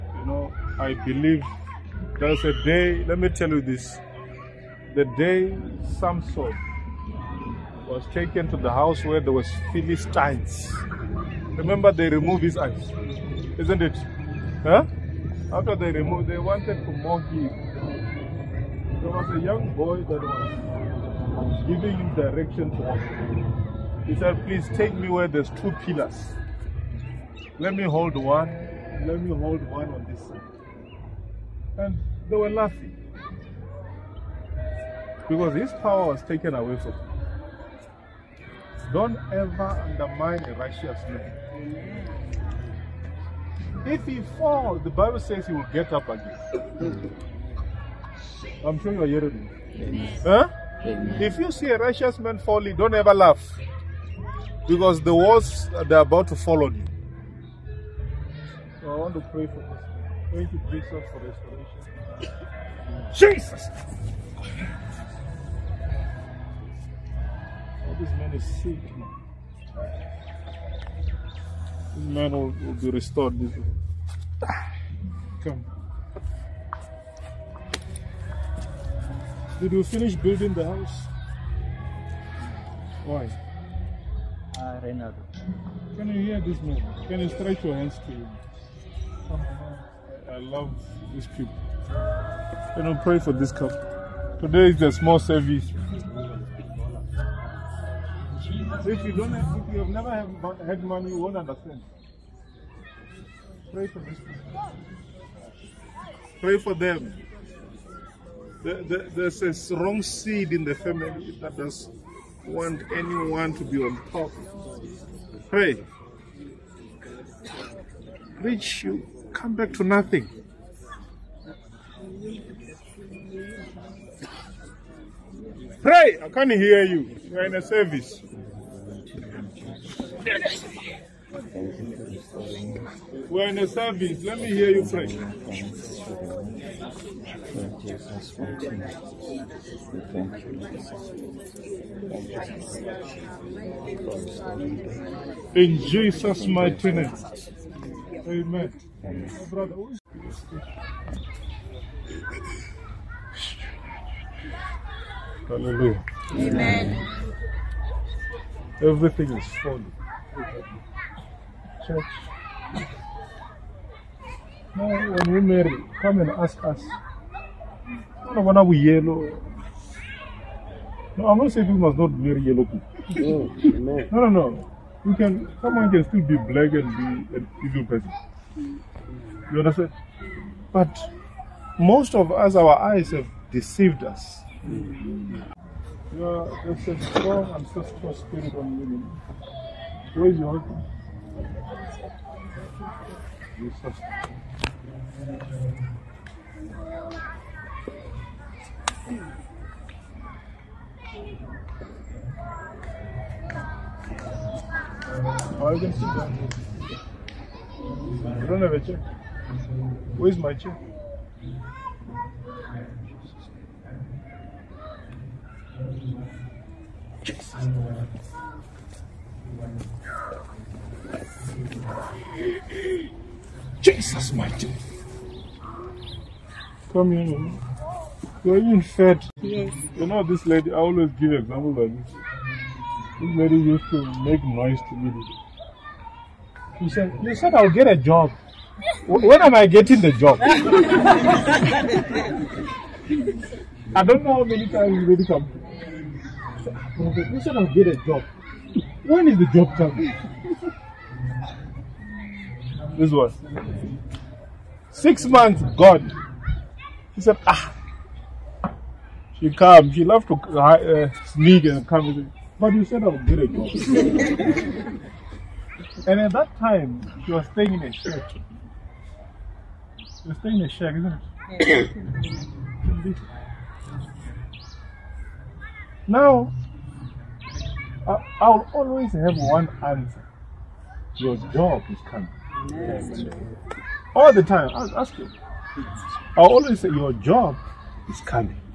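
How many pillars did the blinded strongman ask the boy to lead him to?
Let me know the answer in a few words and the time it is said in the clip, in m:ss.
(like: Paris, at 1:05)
2, at 0:25.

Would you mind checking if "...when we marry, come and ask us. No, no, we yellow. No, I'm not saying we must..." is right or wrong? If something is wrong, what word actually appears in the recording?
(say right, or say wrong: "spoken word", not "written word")
right.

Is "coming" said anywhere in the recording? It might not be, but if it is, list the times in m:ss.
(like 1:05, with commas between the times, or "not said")
4:09, 4:42, 4:48.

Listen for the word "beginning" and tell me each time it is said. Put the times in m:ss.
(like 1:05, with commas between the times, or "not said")
not said.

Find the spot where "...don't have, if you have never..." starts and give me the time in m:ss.
1:39.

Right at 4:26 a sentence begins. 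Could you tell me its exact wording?
and at that time, she was staying in a shack.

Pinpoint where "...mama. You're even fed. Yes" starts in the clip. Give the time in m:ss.
3:47.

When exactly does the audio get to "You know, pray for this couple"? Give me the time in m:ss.
1:32.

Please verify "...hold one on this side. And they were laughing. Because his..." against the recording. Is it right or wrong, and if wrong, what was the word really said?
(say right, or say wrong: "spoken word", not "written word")
right.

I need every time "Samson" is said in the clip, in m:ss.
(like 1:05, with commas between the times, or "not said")
0:05.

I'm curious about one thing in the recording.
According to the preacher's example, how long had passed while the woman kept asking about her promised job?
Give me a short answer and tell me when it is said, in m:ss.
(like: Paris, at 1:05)
6 months, at 4:14.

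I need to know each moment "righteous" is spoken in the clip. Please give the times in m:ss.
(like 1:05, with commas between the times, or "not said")
0:40, 0:51.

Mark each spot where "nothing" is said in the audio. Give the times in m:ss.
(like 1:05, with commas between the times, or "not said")
1:59.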